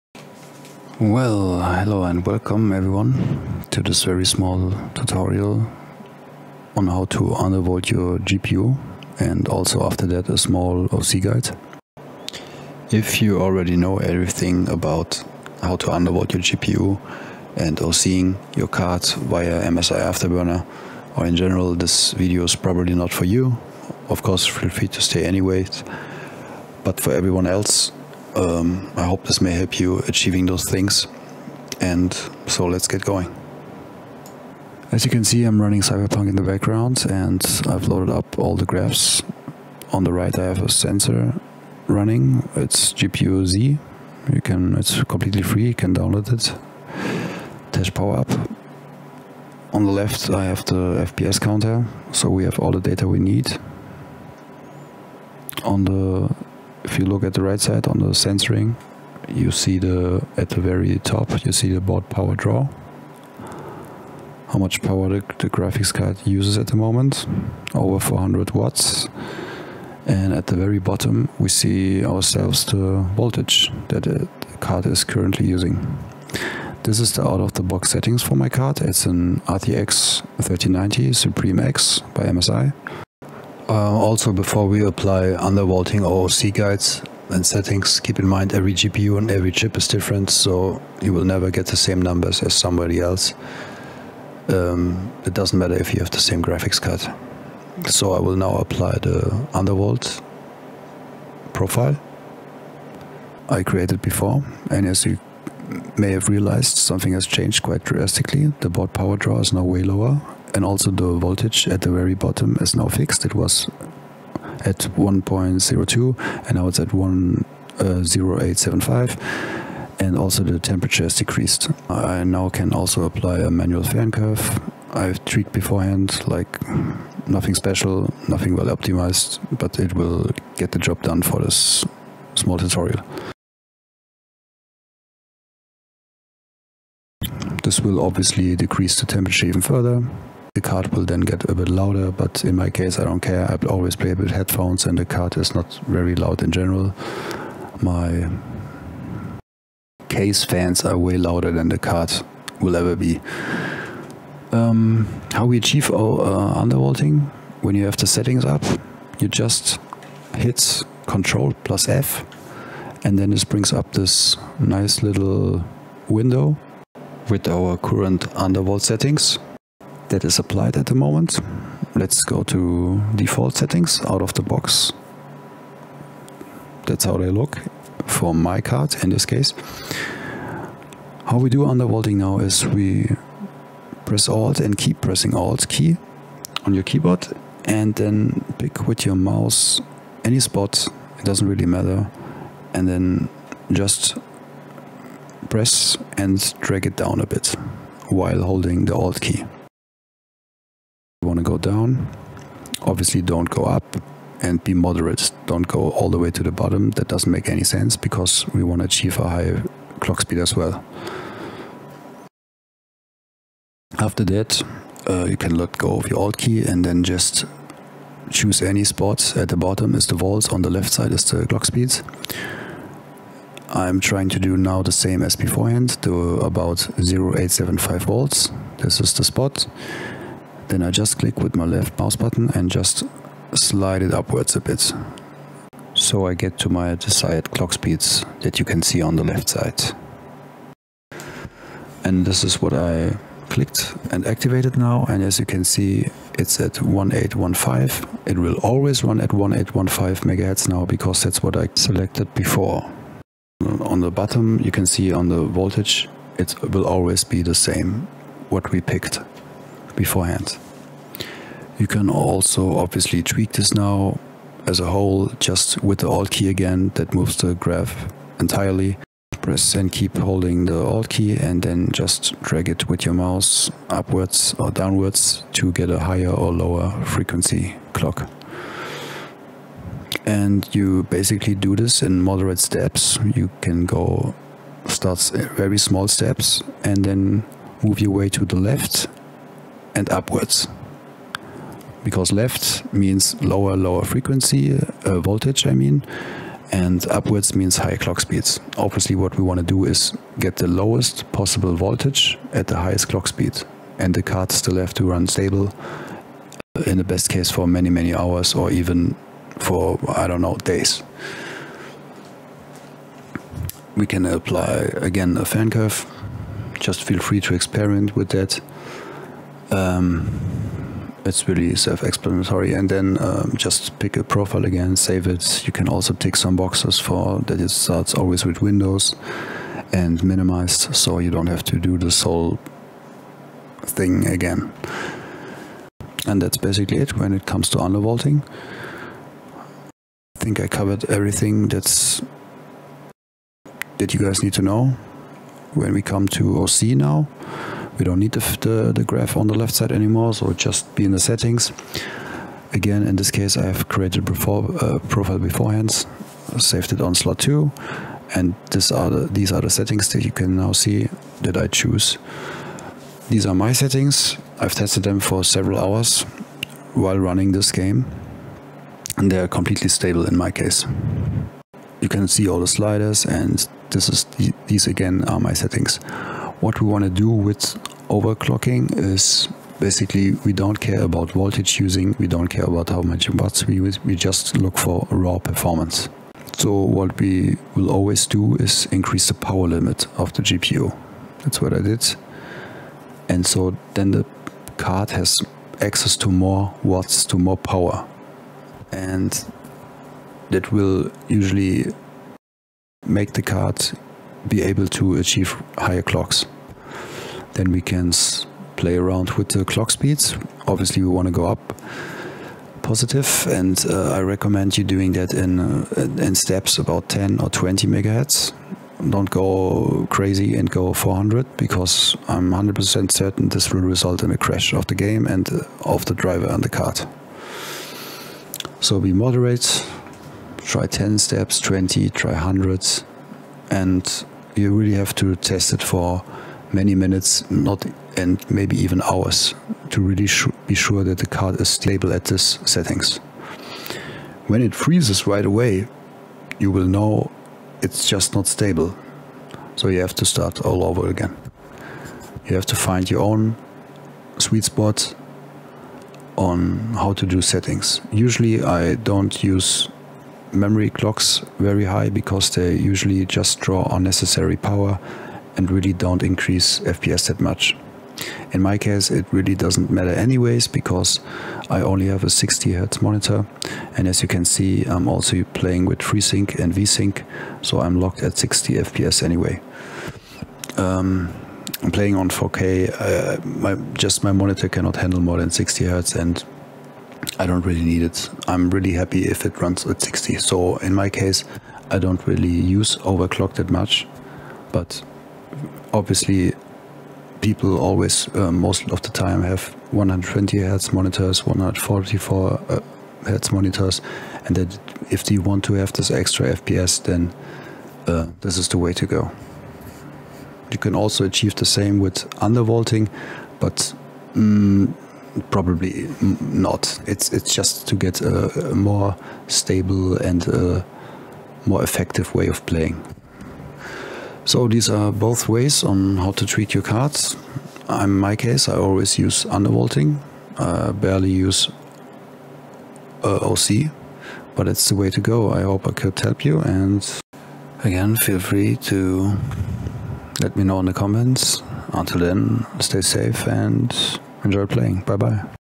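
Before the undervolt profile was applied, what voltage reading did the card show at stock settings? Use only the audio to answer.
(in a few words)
1.02.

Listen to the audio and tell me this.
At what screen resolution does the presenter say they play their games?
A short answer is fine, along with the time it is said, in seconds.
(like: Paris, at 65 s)
4K, at 482 s.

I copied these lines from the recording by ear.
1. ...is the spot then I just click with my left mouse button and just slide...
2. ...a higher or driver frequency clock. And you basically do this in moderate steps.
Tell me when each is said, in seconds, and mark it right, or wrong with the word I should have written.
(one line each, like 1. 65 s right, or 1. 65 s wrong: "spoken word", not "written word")
1. 228 s right
2. 275 s wrong: "lower", not "driver".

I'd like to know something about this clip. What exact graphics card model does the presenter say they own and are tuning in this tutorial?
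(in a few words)
RTX 3090 Suprim X.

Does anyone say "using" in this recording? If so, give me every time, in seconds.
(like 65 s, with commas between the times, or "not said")
75 s, 381 s.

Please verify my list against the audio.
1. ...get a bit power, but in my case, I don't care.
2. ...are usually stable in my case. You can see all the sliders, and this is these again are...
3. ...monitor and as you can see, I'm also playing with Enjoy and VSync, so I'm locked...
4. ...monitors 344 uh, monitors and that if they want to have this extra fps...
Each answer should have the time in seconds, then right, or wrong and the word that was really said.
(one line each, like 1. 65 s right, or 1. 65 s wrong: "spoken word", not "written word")
1. 141 s wrong: "louder", not "power"
2. 369 s wrong: "completely", not "usually"
3. 473 s wrong: "FreeSync", not "Enjoy"
4. 500 s wrong: "144", not "344".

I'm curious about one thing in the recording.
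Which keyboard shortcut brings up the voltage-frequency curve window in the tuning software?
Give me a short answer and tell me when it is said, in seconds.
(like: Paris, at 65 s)
Control plus F, at 161 s.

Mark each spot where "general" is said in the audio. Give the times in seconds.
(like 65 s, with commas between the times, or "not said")
21 s, 146 s.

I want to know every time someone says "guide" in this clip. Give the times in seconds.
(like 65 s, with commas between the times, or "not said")
11 s, 86 s.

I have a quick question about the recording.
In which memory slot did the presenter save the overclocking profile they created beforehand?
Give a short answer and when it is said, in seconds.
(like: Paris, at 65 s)
Slot 2, at 357 s.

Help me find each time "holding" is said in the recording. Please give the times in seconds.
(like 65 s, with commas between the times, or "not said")
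198 s, 270 s.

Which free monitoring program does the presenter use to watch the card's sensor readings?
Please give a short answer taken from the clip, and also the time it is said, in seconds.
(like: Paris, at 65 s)
GPU Z, at 42 s.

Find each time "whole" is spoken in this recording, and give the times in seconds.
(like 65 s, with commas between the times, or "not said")
264 s, 332 s.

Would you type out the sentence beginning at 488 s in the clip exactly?
I'm really happy if it runs at 60.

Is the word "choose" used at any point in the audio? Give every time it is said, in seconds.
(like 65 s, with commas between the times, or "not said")
218 s, 361 s.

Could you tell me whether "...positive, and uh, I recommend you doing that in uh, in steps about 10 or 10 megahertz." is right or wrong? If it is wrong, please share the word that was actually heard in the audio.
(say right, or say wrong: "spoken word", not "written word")
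wrong: "20", not "10".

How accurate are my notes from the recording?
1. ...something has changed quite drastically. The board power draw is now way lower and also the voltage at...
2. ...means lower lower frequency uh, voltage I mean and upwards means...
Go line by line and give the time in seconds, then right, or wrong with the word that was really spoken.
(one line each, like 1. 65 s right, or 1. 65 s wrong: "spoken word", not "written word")
1. 106 s right
2. 292 s right.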